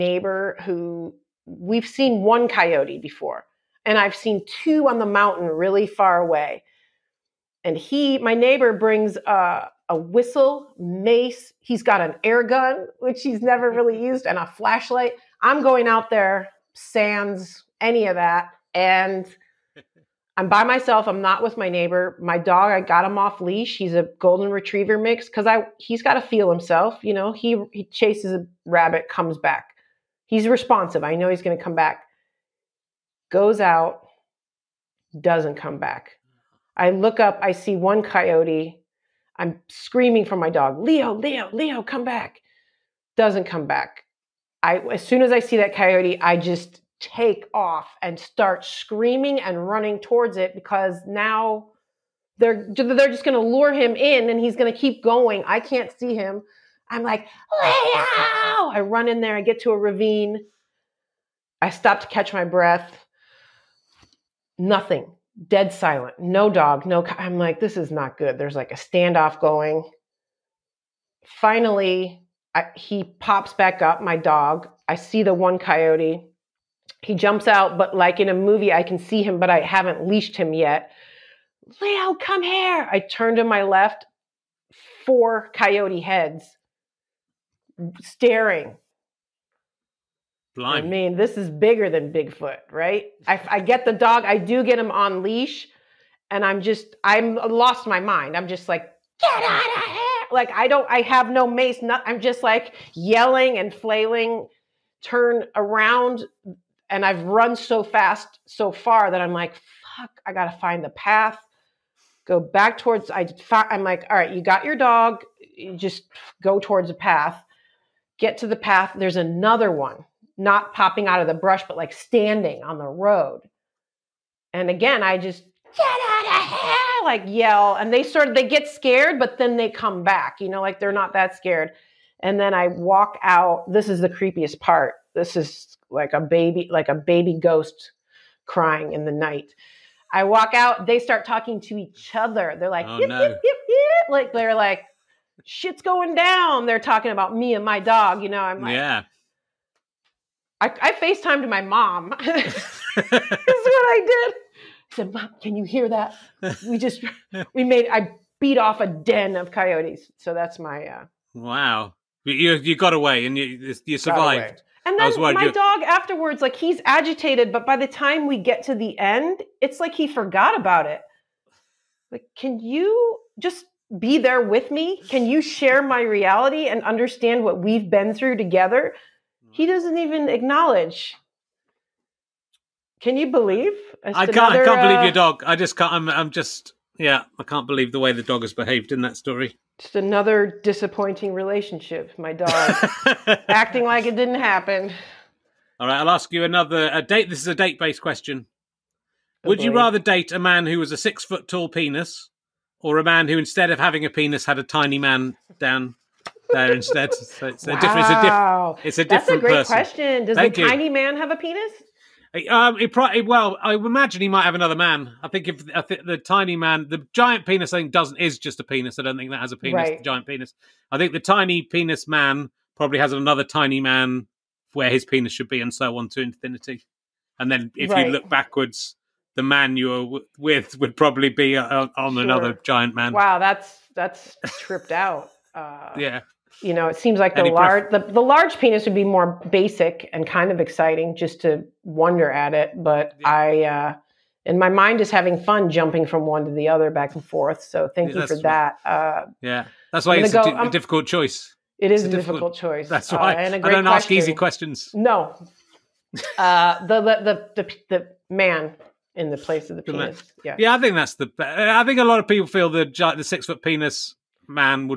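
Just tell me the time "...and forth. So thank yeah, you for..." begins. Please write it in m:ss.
4:07.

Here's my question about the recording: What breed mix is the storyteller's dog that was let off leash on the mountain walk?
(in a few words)
Golden retriever mix.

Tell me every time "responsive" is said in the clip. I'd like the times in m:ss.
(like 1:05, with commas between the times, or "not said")
0:30.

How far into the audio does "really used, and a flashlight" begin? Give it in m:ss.
0:13.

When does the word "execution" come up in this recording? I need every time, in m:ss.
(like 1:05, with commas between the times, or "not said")
not said.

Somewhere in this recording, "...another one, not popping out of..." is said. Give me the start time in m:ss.
1:59.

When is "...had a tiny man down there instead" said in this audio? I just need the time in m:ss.
3:24.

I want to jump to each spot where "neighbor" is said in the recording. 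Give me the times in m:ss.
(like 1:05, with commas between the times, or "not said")
0:08, 0:21.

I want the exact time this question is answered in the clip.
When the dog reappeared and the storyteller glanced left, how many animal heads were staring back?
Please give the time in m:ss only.
1:25.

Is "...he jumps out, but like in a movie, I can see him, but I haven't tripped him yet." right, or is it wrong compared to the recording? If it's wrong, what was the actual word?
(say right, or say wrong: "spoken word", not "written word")
wrong: "leashed", not "tripped".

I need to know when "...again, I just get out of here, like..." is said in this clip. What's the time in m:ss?
2:04.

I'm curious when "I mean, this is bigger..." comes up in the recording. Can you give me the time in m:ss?
1:30.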